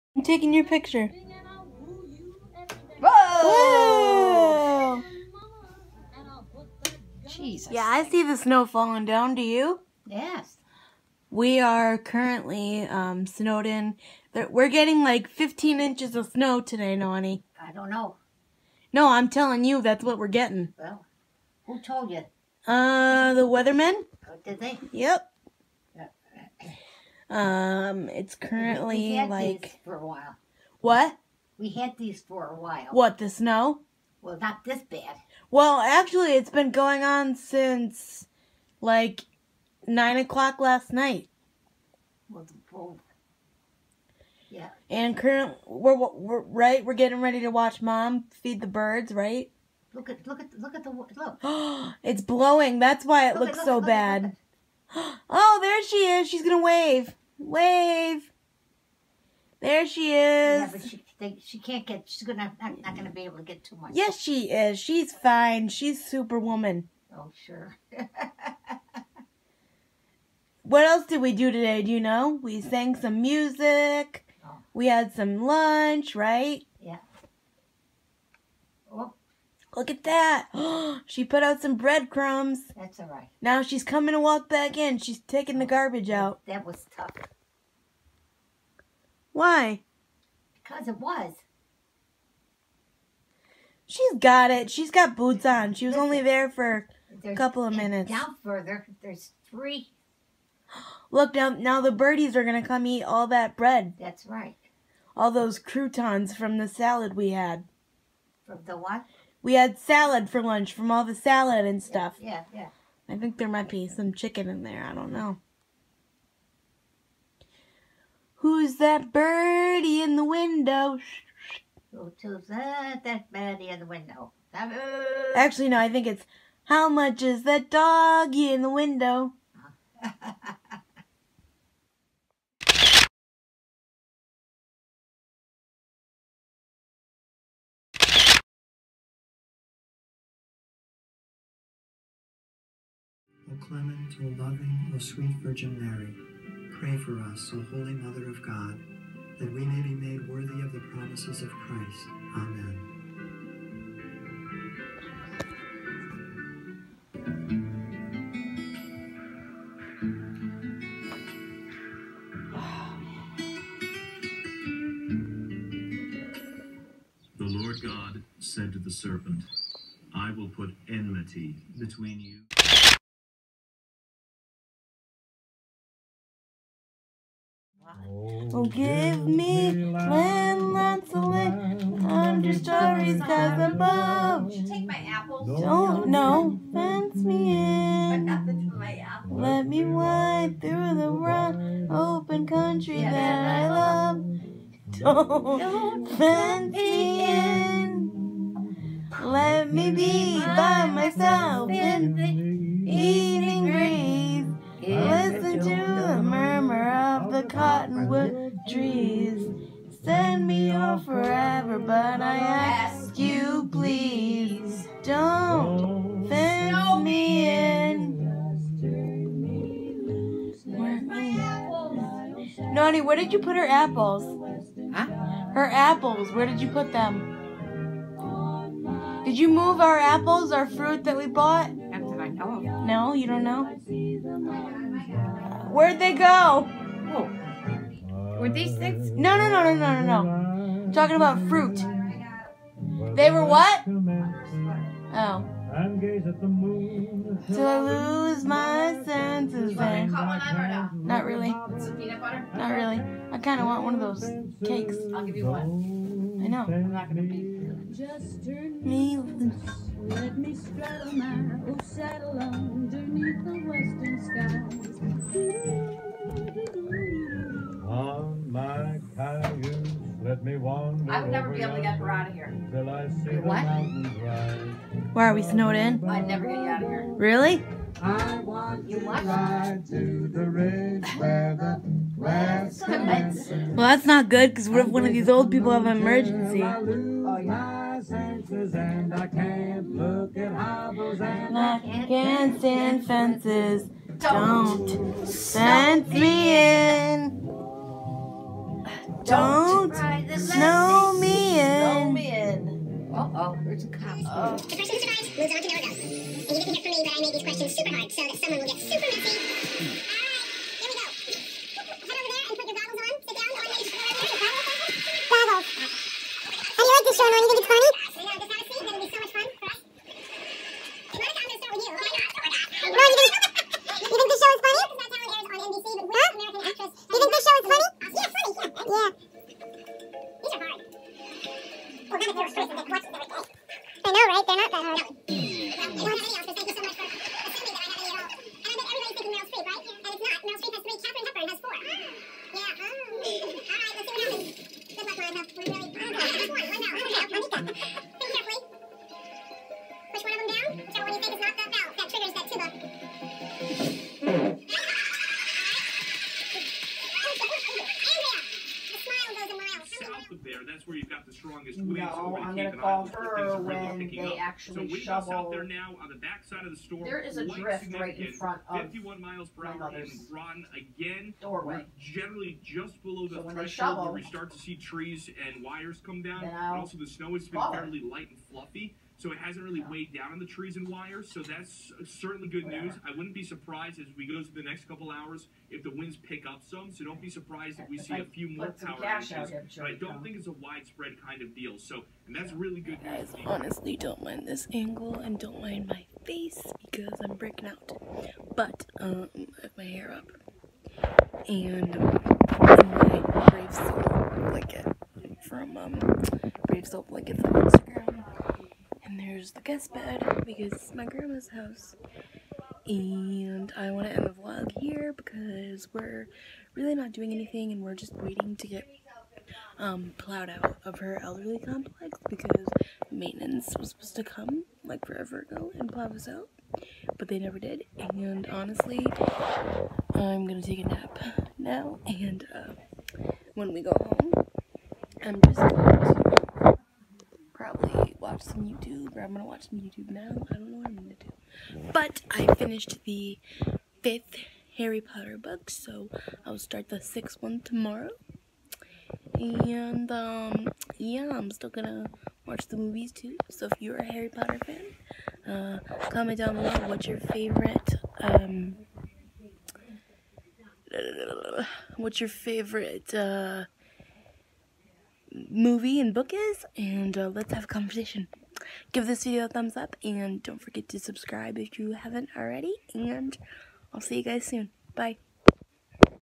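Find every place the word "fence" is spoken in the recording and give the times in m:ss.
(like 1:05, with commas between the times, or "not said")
3:06, 3:16, 3:36, 4:53.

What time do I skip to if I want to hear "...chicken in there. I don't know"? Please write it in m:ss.
1:54.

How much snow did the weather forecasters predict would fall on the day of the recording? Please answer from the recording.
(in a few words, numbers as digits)
15 inches.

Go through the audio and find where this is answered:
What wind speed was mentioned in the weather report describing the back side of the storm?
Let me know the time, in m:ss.
6:08.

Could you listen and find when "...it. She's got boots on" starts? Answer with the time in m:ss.
1:34.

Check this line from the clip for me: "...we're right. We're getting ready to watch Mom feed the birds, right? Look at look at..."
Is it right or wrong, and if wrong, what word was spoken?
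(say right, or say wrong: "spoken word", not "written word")
right.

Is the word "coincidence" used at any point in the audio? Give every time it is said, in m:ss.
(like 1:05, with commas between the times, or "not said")
not said.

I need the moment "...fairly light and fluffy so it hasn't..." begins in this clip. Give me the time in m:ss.
6:17.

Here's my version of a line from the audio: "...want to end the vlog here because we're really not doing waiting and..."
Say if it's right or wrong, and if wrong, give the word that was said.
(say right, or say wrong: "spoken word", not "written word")
wrong: "anything", not "waiting".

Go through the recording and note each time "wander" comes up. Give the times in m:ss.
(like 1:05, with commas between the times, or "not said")
4:30.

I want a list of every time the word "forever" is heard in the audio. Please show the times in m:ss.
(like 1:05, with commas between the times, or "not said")
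3:31, 7:05.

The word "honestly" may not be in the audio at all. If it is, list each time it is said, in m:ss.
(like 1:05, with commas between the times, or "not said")
6:33, 7:08.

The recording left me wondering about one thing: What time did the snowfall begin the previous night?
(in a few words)
9 o'clock.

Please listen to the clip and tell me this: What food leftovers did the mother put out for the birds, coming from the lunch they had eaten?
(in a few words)
Croutons.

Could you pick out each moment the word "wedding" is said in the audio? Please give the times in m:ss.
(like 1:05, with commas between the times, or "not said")
not said.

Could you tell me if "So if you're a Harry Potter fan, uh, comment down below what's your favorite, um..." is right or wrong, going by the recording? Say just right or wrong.
right.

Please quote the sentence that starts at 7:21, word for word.
But I finished the fifth Harry Potter book, so I'll start the sixth one tomorrow.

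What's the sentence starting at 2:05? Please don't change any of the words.
Actually, no, I think it's how much is that doggy in the window?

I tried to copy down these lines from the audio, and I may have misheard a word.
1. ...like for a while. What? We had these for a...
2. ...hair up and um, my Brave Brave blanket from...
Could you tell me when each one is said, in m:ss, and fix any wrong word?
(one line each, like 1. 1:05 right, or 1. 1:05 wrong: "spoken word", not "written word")
1. 0:29 right
2. 6:39 wrong: "Soul", not "Brave".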